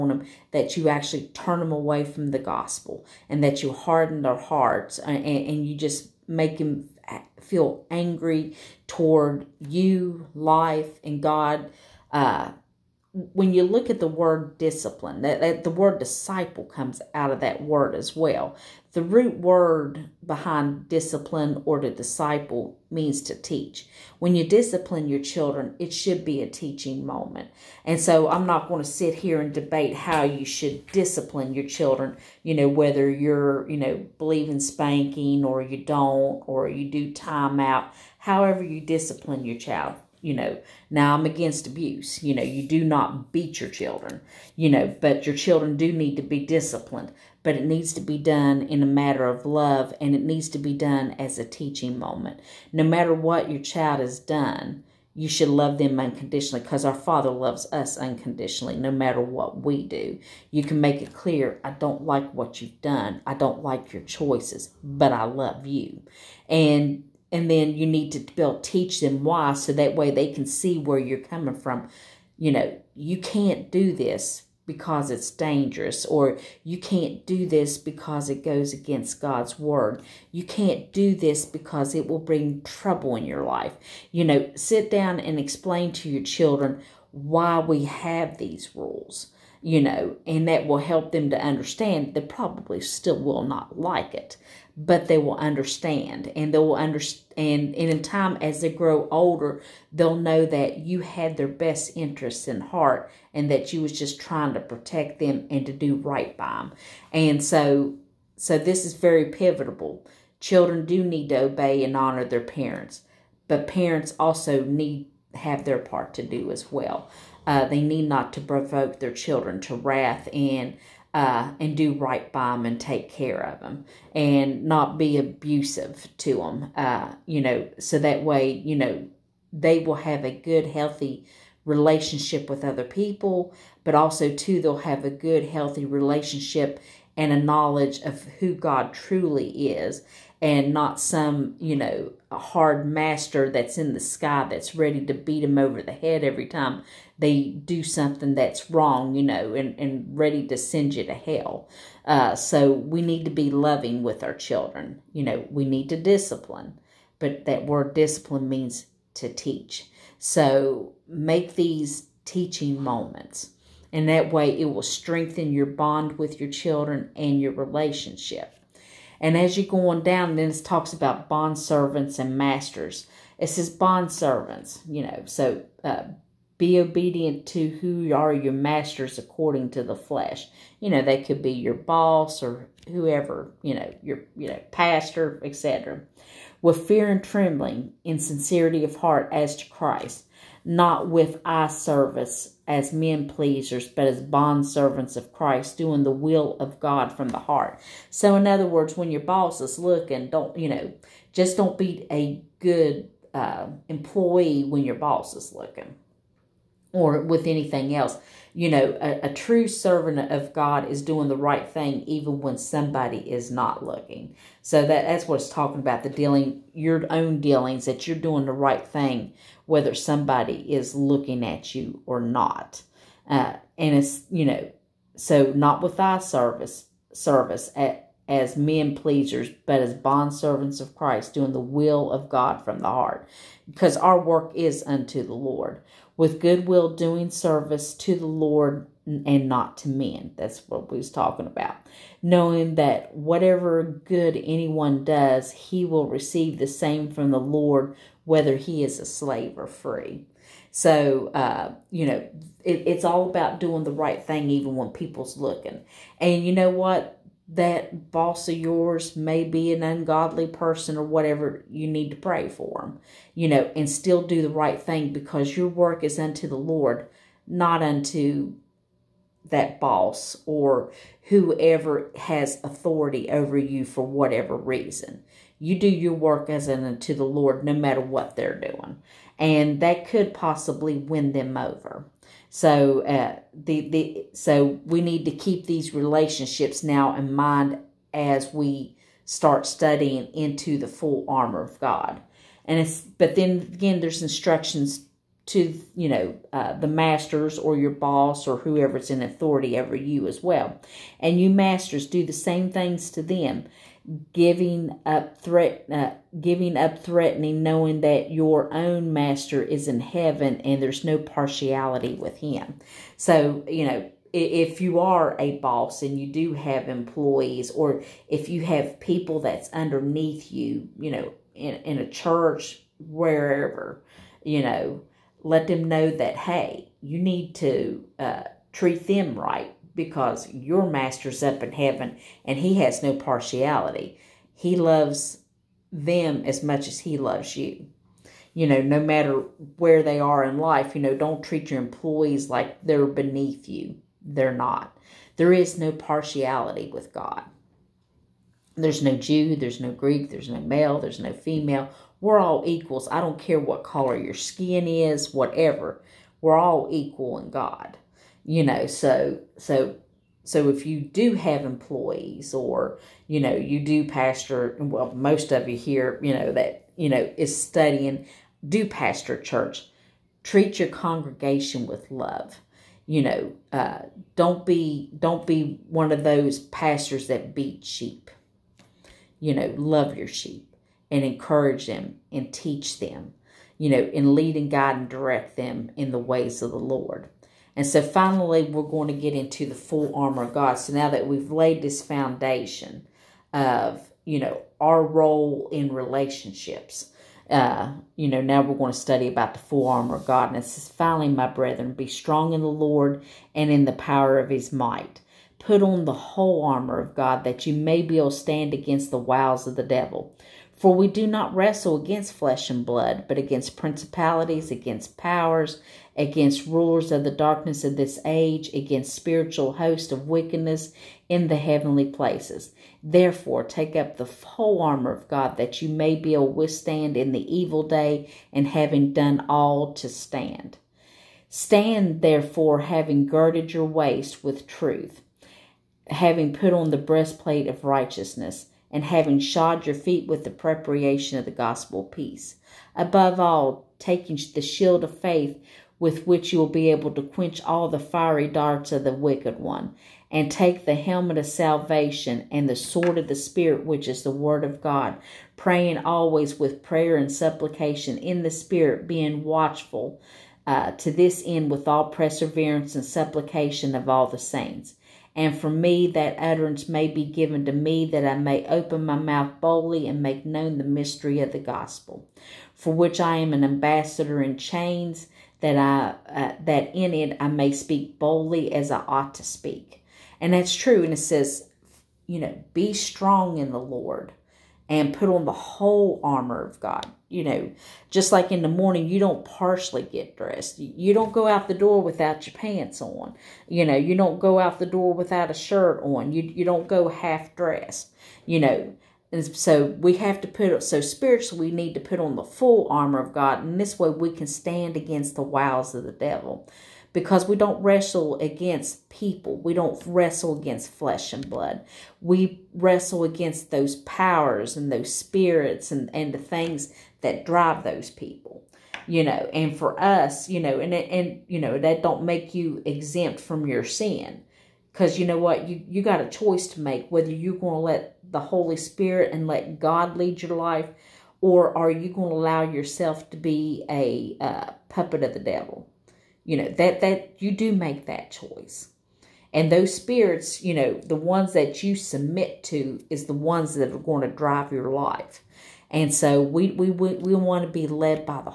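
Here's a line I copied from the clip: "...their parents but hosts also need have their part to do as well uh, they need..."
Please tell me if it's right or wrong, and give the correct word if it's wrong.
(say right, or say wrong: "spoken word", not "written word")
wrong: "parents", not "hosts".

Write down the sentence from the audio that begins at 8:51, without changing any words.
Or are you going to allow yourself to be a uh, puppet of the devil?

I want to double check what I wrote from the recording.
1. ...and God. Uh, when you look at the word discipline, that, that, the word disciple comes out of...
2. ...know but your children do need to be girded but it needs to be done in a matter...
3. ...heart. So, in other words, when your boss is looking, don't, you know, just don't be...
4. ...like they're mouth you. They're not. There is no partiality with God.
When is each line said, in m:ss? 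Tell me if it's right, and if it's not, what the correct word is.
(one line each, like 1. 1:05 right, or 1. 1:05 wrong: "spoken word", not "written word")
1. 0:11 right
2. 0:44 wrong: "disciplined", not "girded"
3. 3:17 right
4. 5:42 wrong: "beneath", not "mouth".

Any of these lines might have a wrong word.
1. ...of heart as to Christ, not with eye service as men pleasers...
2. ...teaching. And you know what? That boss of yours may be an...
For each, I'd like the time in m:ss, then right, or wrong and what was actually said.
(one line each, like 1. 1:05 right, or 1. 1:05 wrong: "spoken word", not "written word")
1. 3:08 right
2. 4:15 wrong: "looking", not "teaching".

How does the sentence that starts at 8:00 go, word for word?
And that's true and it says you know, be strong in the Lord and put on the whole armor of God.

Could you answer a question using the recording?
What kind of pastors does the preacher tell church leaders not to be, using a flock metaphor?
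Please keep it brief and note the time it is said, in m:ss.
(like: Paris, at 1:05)
Pastors that beat sheep, at 6:16.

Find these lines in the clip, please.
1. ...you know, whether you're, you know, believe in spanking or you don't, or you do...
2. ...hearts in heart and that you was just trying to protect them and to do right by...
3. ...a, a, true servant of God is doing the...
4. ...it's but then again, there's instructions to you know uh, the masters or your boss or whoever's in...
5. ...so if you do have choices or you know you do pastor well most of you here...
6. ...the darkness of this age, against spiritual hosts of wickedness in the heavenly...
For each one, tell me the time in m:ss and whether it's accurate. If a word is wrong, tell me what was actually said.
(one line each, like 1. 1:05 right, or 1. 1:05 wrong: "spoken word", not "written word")
1. 0:32 right
2. 1:41 wrong: "interests", not "hearts"
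3. 3:28 right
4. 4:52 right
5. 6:00 wrong: "employees", not "choices"
6. 6:57 right.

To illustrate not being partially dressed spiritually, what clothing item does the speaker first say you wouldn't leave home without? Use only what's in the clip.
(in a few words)
Pants.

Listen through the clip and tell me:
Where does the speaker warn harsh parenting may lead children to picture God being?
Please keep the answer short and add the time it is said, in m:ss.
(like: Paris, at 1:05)
In the sky, at 2:23.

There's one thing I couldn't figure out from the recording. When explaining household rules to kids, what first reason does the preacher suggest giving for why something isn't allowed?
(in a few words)
Dangerous.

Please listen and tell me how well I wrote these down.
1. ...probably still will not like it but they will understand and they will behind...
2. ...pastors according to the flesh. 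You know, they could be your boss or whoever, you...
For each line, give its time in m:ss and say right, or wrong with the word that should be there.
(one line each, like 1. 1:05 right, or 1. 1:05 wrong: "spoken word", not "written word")
1. 1:32 wrong: "understand", not "behind"
2. 2:58 wrong: "masters", not "pastors".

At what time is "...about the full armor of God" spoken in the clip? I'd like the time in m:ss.
6:39.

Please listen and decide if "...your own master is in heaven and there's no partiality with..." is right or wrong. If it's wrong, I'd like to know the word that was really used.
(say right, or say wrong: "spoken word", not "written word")
right.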